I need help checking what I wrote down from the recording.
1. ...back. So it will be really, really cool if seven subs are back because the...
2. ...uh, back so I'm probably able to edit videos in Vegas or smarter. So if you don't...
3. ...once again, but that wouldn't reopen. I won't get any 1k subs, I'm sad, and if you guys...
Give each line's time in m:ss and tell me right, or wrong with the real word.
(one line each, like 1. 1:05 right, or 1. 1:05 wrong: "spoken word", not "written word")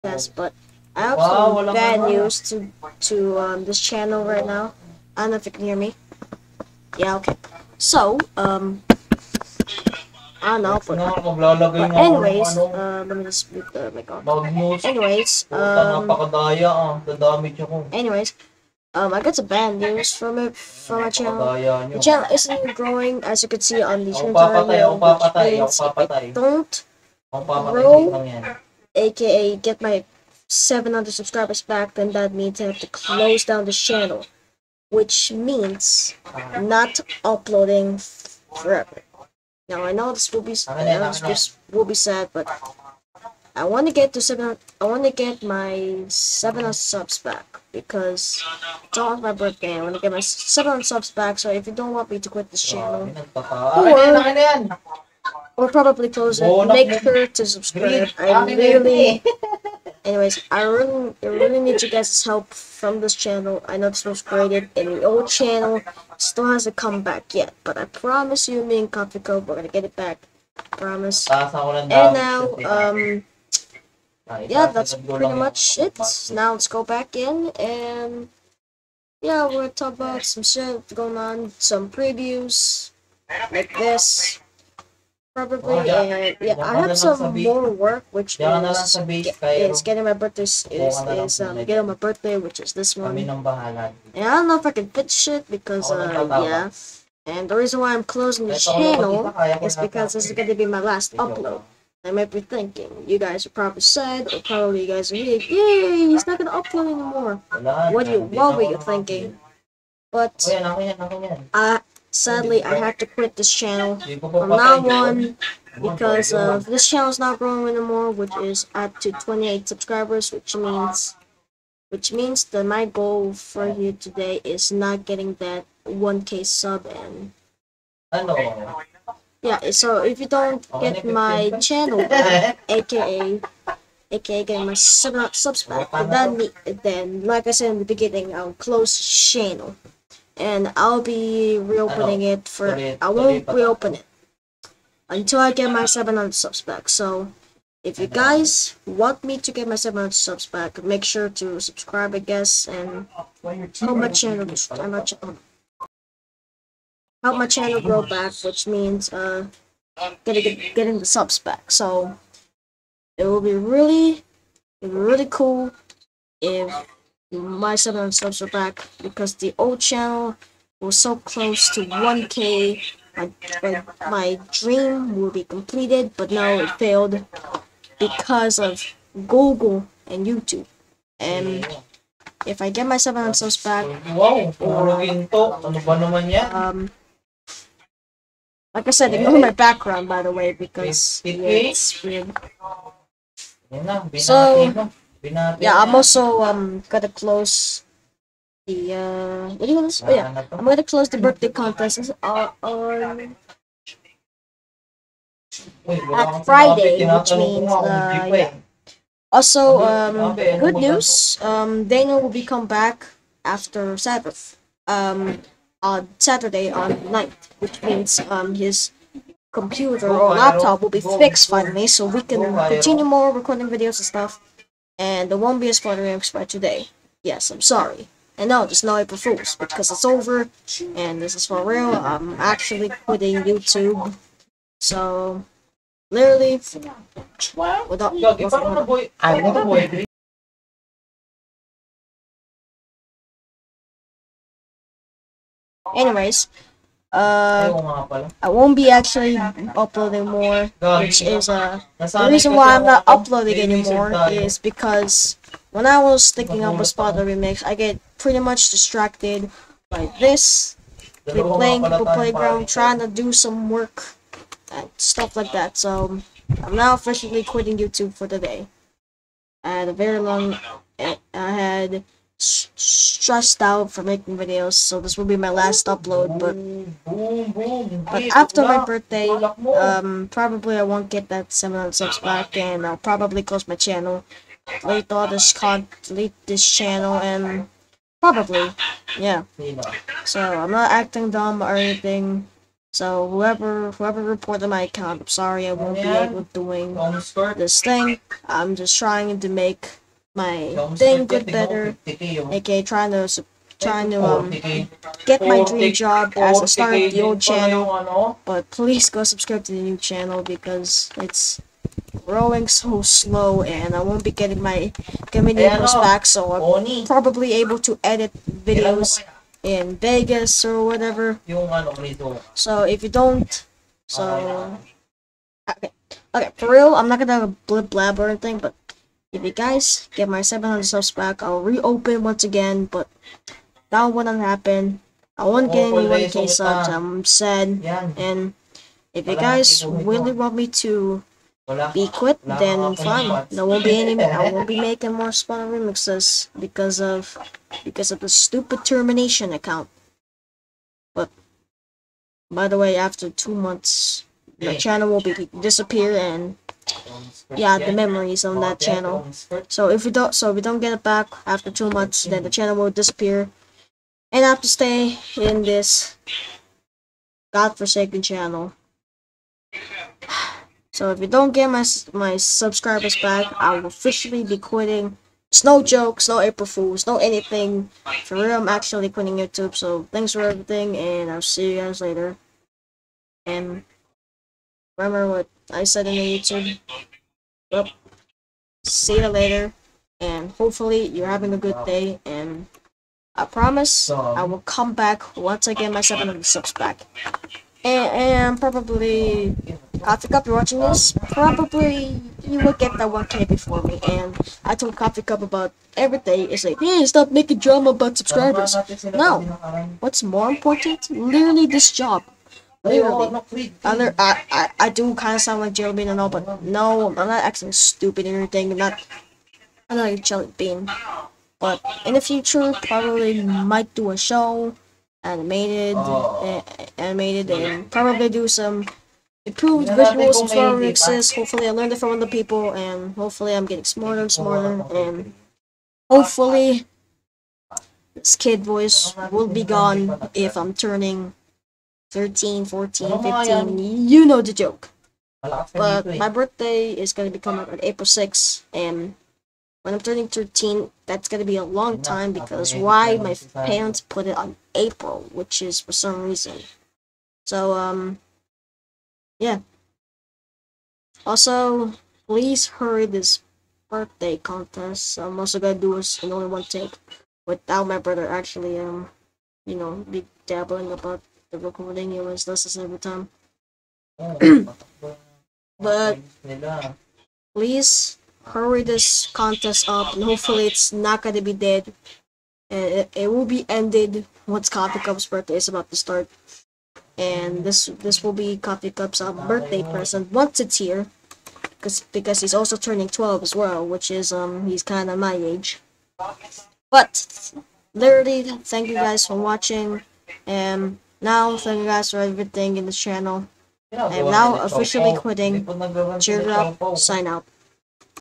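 1. 2:41 right
2. 5:15 wrong: "whatever", not "smarter"
3. 5:32 wrong: "happen", not "reopen".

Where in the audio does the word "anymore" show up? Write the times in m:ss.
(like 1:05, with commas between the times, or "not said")
1:46, 1:57, 4:13.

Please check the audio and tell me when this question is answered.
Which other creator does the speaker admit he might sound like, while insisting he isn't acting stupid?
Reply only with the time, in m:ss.
6:55.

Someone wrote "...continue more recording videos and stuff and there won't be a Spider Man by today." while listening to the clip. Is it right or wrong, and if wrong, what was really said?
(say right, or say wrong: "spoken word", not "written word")
right.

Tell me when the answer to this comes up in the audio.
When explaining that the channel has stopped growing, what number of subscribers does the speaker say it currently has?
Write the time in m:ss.
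1:59.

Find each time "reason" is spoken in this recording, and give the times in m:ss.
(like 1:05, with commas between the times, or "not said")
1:37, 4:12, 7:36.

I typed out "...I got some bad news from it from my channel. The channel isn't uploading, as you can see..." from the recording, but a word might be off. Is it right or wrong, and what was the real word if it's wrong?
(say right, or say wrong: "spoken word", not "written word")
wrong: "growing", not "uploading".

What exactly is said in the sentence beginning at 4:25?
So I'm now officially quitting YouTube for the day.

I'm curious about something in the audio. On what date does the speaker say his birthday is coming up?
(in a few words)
April 6.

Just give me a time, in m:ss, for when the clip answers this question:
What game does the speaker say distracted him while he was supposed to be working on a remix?
4:21.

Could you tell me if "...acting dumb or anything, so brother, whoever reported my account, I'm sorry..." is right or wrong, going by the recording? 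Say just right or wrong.
wrong.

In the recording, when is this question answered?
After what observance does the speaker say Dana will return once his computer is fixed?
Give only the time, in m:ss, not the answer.
3:33.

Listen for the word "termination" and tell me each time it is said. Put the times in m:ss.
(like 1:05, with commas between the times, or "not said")
5:48.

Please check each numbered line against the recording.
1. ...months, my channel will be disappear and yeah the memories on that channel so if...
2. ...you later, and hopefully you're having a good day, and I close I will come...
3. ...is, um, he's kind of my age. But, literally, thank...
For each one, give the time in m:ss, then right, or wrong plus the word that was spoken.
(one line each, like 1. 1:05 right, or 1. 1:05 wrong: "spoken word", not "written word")
1. 5:53 right
2. 6:29 wrong: "promise", not "close"
3. 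8:14 right.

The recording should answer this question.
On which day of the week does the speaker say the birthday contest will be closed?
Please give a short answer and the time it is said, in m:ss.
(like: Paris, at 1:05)
Friday, at 3:26.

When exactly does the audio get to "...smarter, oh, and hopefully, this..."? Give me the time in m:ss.
7:14.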